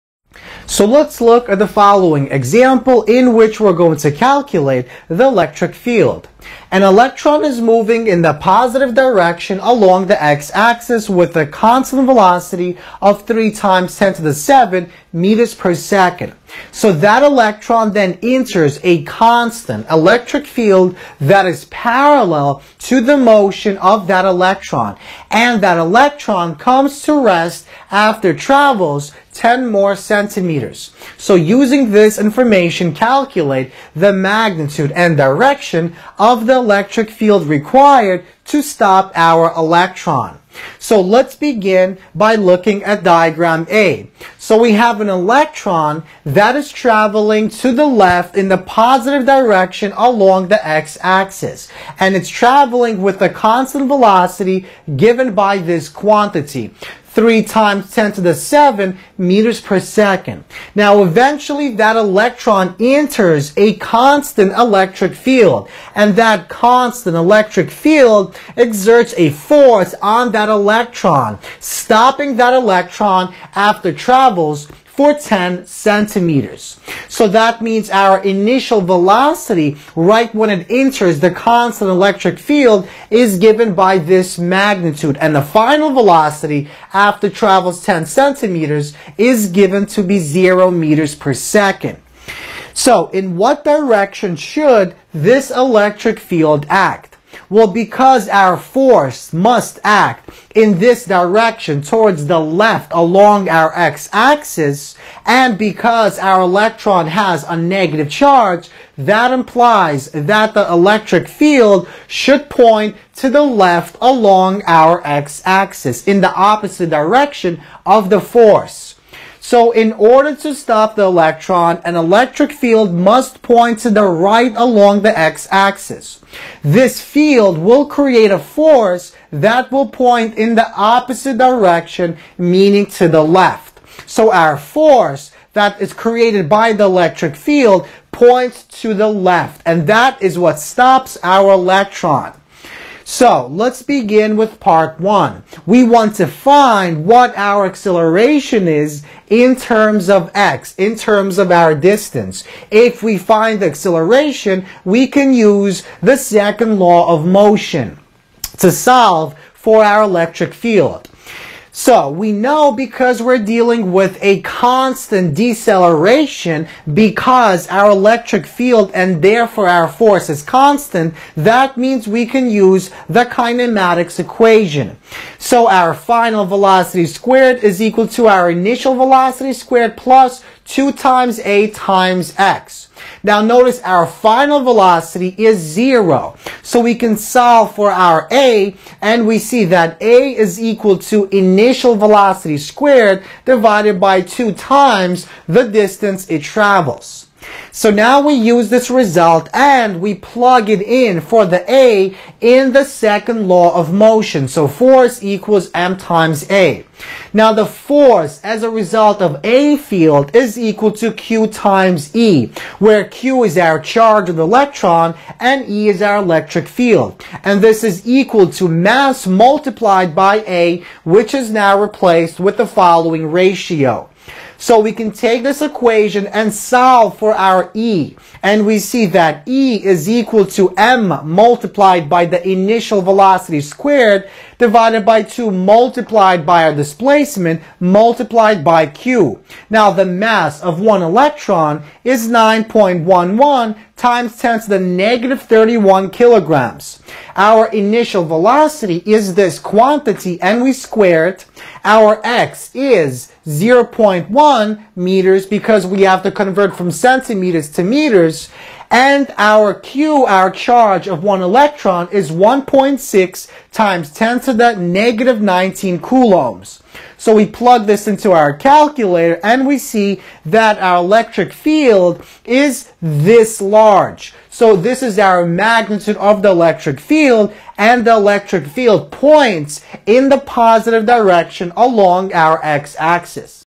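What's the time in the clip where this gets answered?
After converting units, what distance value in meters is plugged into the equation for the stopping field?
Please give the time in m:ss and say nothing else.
4:13.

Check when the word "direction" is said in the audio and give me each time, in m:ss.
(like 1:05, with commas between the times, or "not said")
0:08, 0:35, 0:49, 1:33, 1:41, 1:56, 2:11, 4:41.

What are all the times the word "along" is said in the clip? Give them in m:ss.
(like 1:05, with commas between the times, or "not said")
0:09, 0:49, 1:42, 1:54, 2:04, 4:41.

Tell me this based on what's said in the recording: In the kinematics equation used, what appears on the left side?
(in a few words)
final velocity squared.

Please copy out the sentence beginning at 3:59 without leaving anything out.
Now the mass of one electron is 9.11 times 10 to the negative 31 kilograms.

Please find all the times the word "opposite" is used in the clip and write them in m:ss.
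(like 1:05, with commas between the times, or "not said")
1:56, 2:10.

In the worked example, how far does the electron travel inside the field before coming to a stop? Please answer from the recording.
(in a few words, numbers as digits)
10 centimeters.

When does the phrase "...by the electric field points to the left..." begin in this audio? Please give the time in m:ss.
2:16.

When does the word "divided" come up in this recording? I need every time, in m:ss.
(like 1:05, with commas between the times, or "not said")
3:13, 3:54.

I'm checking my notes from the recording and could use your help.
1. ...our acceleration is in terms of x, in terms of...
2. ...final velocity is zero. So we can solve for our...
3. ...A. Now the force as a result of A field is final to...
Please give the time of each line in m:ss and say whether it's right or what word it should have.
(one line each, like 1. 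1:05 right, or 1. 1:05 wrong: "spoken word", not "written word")
1. 2:27 right
2. 3:04 right
3. 3:26 wrong: "equal", not "final".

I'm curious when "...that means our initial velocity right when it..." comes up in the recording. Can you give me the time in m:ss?
1:17.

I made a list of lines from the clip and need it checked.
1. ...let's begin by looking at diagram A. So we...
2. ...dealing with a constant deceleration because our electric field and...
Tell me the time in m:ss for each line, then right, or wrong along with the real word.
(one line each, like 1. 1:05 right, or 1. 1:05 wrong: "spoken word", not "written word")
1. 0:40 right
2. 2:43 right.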